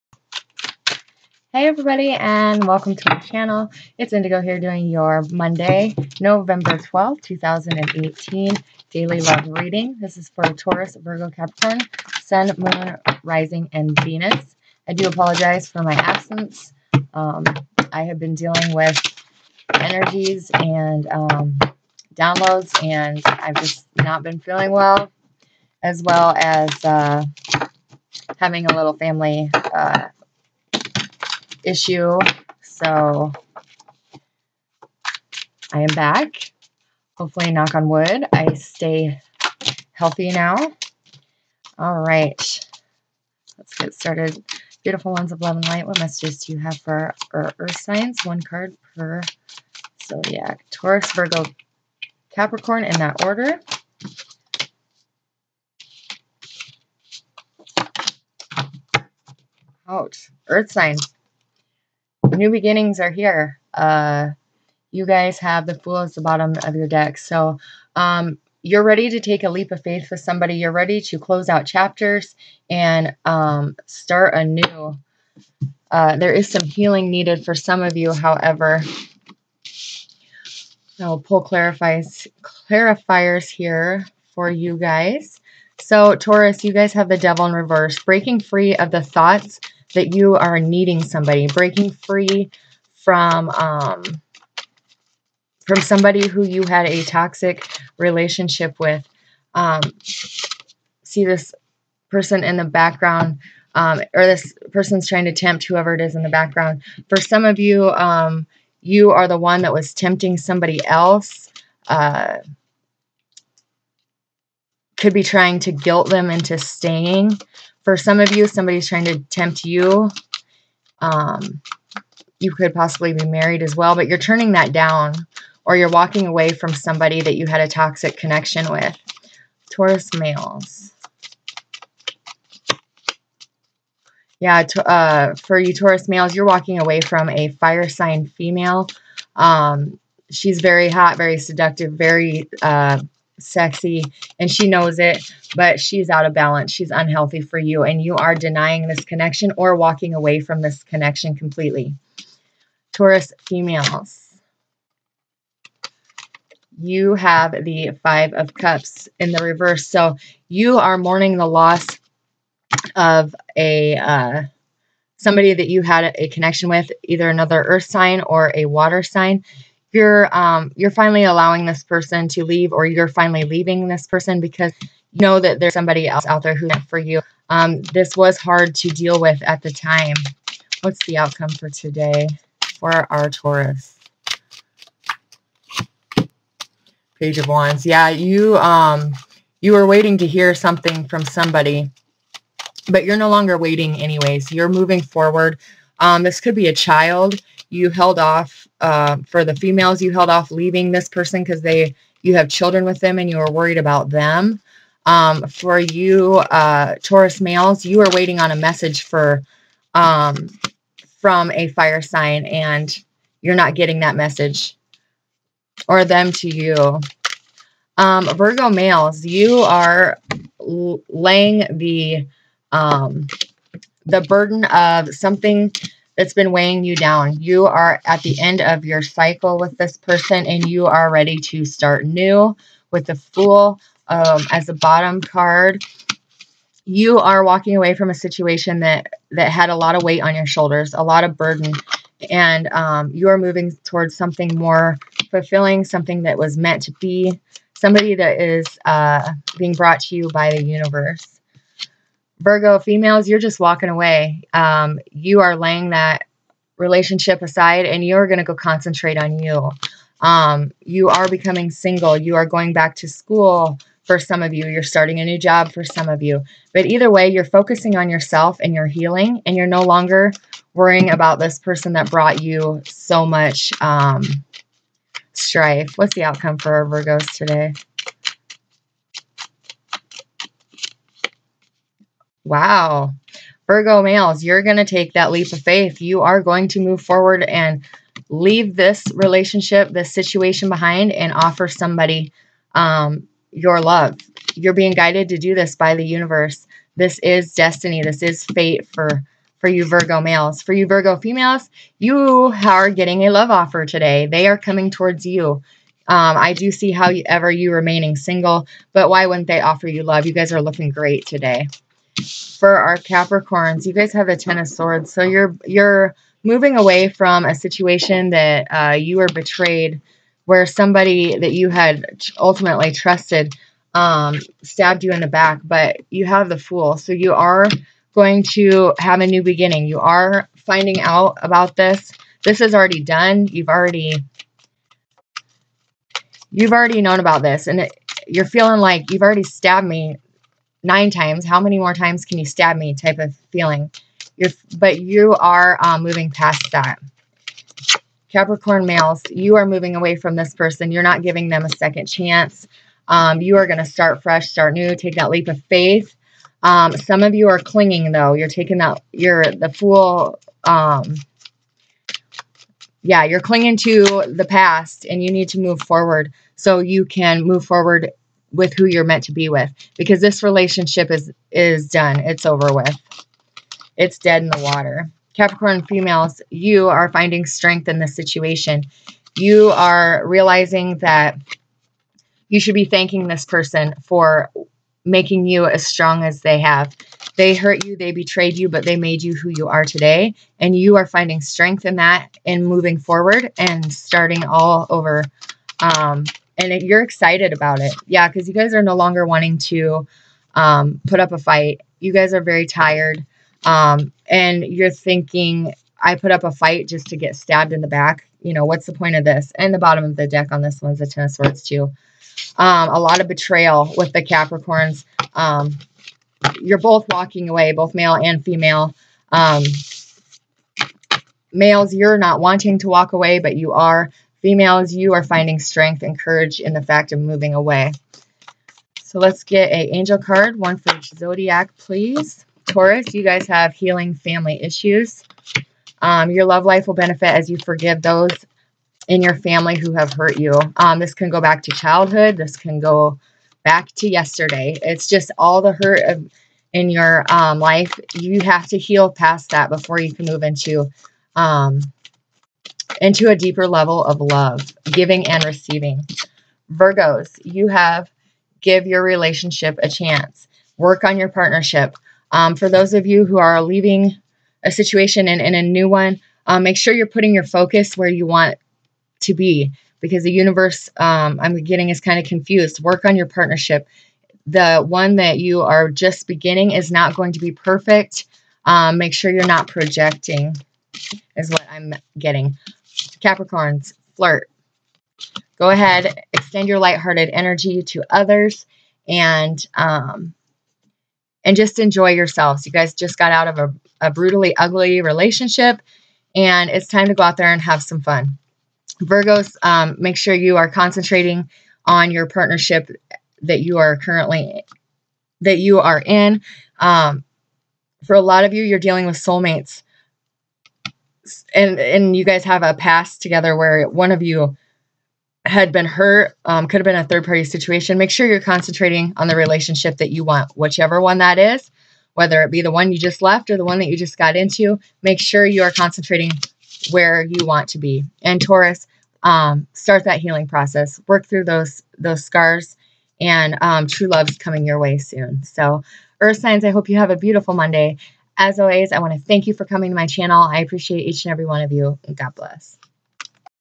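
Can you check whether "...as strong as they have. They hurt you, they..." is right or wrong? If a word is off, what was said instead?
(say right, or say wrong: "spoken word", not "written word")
right.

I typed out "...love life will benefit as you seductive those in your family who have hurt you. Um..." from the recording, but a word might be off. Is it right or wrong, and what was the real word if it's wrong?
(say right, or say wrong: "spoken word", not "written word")
wrong: "forgive", not "seductive".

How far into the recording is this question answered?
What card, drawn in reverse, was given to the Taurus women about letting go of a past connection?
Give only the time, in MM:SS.
02:38.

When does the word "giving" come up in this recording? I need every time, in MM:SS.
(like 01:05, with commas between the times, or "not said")
05:51, 07:34.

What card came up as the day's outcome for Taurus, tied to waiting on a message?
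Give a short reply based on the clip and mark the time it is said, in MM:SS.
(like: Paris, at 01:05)
Page of Wands, at 03:07.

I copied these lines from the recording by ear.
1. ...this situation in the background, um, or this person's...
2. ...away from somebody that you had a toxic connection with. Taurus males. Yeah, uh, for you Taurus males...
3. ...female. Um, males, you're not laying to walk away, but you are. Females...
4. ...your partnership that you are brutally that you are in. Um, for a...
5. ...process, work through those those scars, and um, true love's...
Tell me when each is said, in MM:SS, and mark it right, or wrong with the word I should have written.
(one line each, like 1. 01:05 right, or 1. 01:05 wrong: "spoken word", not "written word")
1. 01:41 wrong: "person", not "situation"
2. 02:06 right
3. 06:58 wrong: "wanting", not "laying"
4. 08:22 wrong: "currently", not "brutally"
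5. 08:50 right.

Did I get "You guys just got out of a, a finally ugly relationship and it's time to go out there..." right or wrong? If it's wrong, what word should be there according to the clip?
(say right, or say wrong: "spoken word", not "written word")
wrong: "brutally", not "finally".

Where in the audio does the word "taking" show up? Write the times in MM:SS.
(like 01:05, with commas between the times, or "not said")
05:58.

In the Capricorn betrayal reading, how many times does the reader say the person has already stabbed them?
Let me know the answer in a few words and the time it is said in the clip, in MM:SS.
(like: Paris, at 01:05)
9, at 05:40.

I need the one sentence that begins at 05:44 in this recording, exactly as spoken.
You're, but you are uh, moving past that.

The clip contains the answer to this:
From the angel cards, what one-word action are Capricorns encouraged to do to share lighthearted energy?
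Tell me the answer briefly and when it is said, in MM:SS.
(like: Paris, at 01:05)
Flirt, at 08:04.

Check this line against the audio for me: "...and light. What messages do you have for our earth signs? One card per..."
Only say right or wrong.
right.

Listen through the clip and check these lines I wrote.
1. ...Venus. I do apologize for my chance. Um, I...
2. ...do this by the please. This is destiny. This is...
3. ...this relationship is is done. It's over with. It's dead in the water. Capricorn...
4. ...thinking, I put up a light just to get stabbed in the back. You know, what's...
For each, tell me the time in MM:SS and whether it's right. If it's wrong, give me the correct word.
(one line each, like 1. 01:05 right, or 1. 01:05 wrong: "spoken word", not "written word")
1. 00:14 wrong: "absence", not "chance"
2. 04:55 wrong: "universe", not "please"
3. 06:10 right
4. 06:44 wrong: "fight", not "light".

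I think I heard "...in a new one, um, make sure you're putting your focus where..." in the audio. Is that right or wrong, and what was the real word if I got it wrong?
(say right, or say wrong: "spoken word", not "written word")
right.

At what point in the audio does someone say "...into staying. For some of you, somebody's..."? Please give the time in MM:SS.
01:56.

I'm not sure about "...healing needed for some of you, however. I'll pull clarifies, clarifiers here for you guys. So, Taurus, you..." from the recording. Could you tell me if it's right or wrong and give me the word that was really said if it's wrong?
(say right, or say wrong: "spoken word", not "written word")
right.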